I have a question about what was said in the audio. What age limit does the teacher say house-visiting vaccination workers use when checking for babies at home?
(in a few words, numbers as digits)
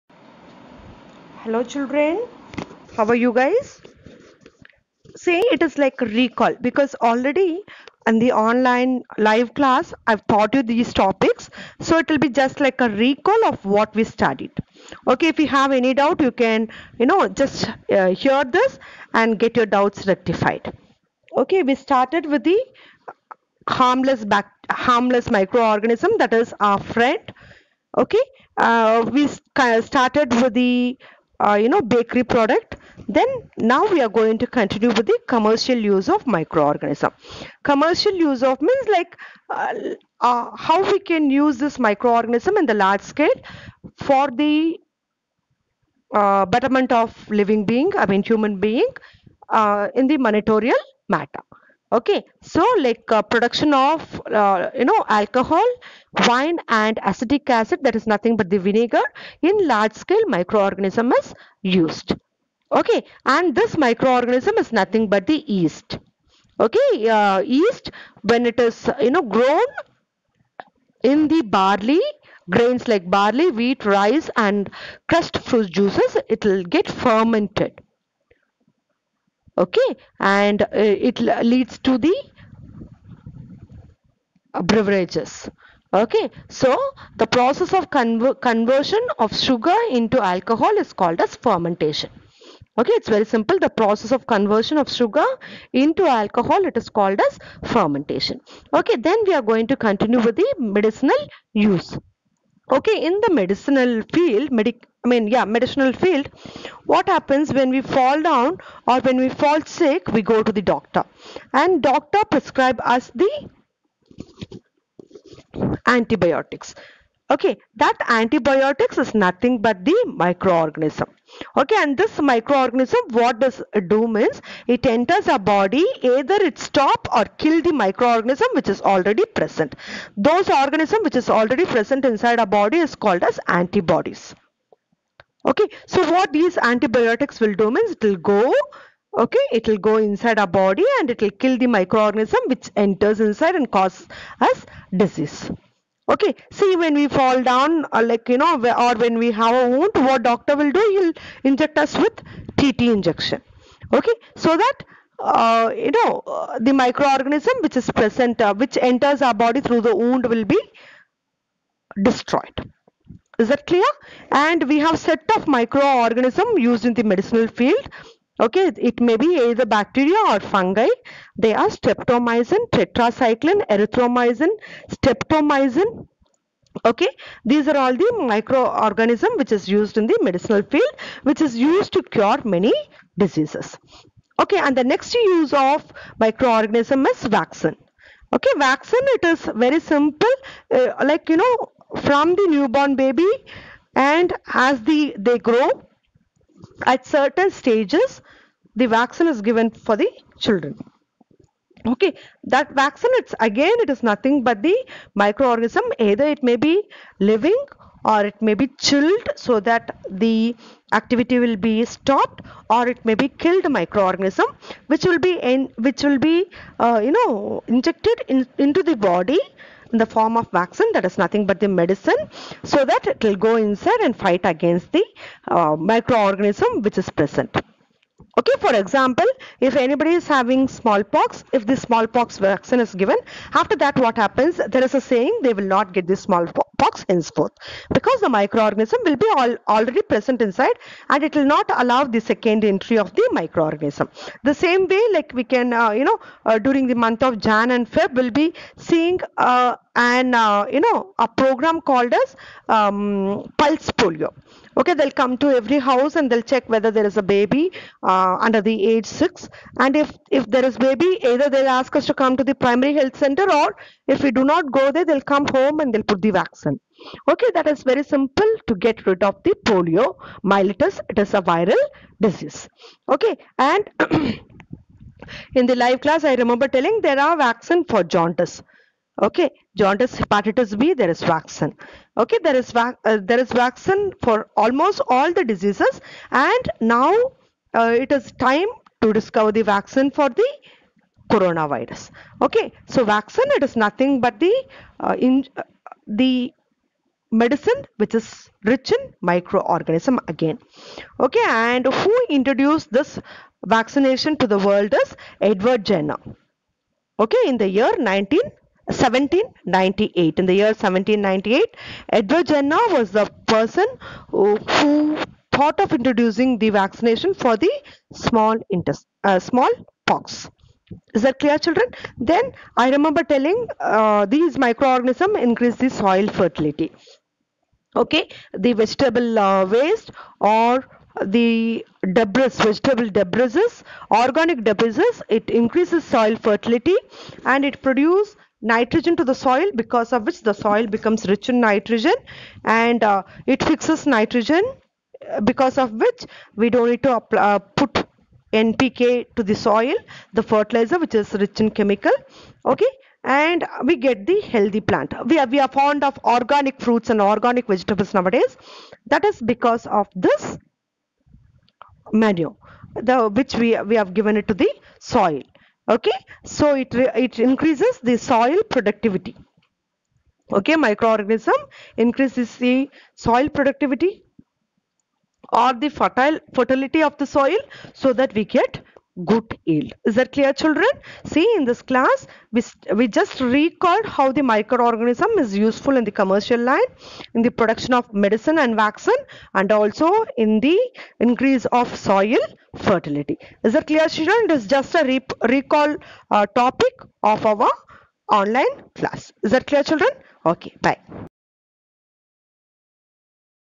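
6.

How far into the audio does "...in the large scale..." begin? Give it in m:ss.
0:42.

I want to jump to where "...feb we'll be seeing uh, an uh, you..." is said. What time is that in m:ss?
4:07.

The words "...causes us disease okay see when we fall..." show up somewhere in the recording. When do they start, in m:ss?
2:23.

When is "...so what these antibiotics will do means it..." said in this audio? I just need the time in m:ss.
2:15.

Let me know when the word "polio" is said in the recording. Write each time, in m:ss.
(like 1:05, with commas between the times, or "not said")
4:14, 4:29.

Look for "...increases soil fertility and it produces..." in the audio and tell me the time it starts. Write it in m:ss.
5:35.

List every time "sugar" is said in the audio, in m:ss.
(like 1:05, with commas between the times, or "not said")
1:29, 1:34.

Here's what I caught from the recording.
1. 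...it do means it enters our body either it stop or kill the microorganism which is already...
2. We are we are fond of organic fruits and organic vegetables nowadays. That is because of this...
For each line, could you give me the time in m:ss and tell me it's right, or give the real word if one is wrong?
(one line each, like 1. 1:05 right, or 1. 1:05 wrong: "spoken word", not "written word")
1. 2:03 right
2. 5:55 right.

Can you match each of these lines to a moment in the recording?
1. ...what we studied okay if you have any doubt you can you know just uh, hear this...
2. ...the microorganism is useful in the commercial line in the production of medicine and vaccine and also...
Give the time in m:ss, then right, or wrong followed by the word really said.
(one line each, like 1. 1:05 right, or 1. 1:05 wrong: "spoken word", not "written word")
1. 0:13 right
2. 6:24 right.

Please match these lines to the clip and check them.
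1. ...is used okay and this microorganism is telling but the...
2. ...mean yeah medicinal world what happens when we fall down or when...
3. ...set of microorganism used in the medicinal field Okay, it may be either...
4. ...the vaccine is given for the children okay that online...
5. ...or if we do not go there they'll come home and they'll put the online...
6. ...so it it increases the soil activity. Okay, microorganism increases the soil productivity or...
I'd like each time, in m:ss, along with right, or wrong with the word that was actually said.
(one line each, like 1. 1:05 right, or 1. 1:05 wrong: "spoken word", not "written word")
1. 1:01 wrong: "nothing", not "telling"
2. 1:45 wrong: "field", not "world"
3. 2:45 right
4. 3:18 wrong: "vaccine", not "online"
5. 4:23 wrong: "vaccine", not "online"
6. 6:06 wrong: "productivity", not "activity".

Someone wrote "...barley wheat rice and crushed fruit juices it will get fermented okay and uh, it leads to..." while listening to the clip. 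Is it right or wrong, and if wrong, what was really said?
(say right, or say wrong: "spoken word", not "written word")
right.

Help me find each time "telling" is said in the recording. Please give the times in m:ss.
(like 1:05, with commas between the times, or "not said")
4:36, 5:23.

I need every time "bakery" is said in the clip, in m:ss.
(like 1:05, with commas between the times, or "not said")
0:31.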